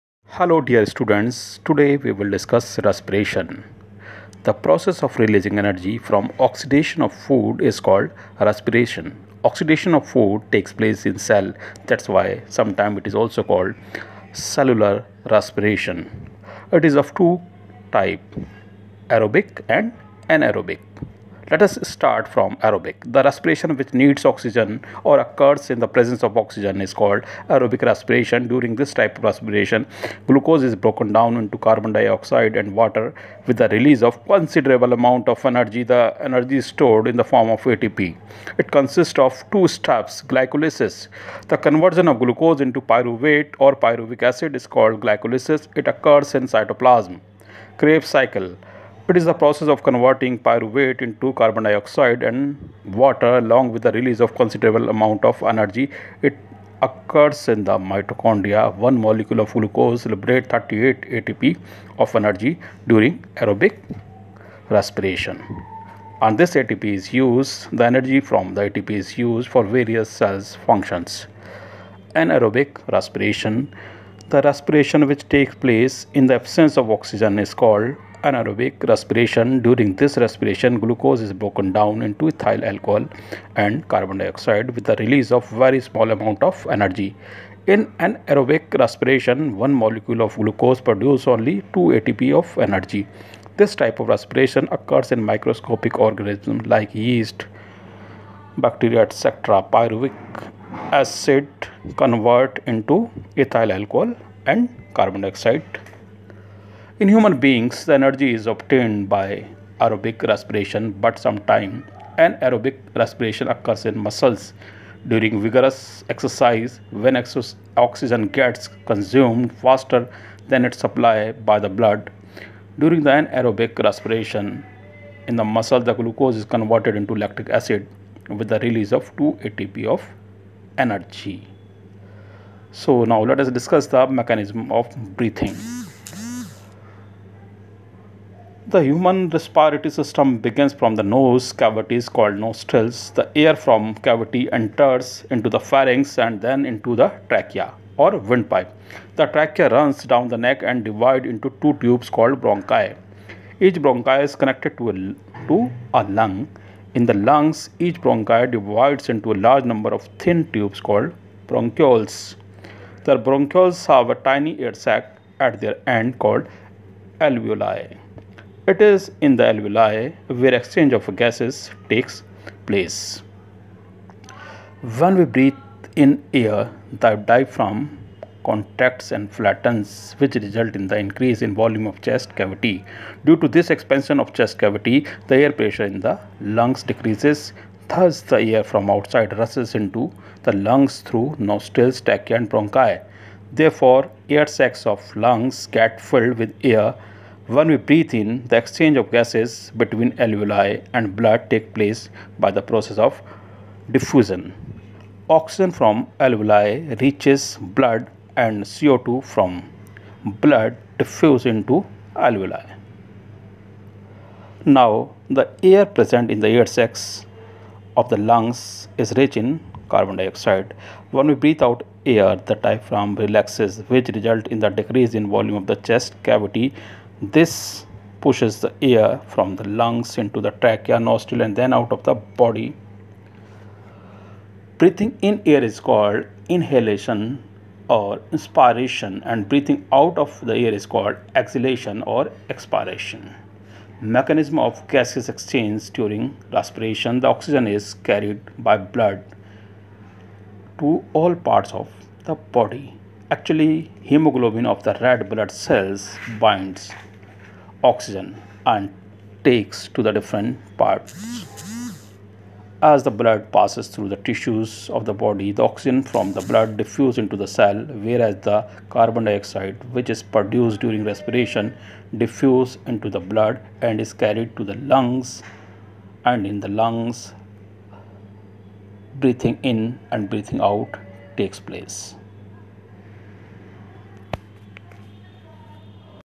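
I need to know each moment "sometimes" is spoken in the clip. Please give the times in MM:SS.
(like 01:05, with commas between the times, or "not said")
00:12, 01:51.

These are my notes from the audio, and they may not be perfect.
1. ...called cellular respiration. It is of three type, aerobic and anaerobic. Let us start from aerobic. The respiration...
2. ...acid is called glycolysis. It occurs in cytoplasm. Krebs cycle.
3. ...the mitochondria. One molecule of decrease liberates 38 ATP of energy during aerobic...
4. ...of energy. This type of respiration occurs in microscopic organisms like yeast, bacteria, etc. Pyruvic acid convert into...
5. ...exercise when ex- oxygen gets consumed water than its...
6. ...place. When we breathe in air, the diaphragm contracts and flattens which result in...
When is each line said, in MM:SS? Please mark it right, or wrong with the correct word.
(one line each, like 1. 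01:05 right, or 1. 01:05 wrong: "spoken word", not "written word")
1. 00:13 wrong: "two", not "three"
2. 00:44 right
3. 00:57 wrong: "glucose", not "decrease"
4. 01:32 right
5. 01:56 wrong: "faster", not "water"
6. 02:52 right.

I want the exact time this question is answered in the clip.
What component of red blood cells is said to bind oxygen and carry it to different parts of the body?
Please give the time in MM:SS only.
04:14.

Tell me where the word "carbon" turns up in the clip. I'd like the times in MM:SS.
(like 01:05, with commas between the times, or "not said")
00:31, 00:51, 01:23, 01:44, 03:39, 04:28.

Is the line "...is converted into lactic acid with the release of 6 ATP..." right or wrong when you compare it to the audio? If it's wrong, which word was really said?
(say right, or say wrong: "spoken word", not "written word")
wrong: "2", not "6".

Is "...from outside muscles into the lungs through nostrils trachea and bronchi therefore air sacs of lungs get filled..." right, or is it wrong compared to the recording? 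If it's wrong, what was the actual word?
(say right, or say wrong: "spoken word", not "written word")
wrong: "rushes", not "muscles".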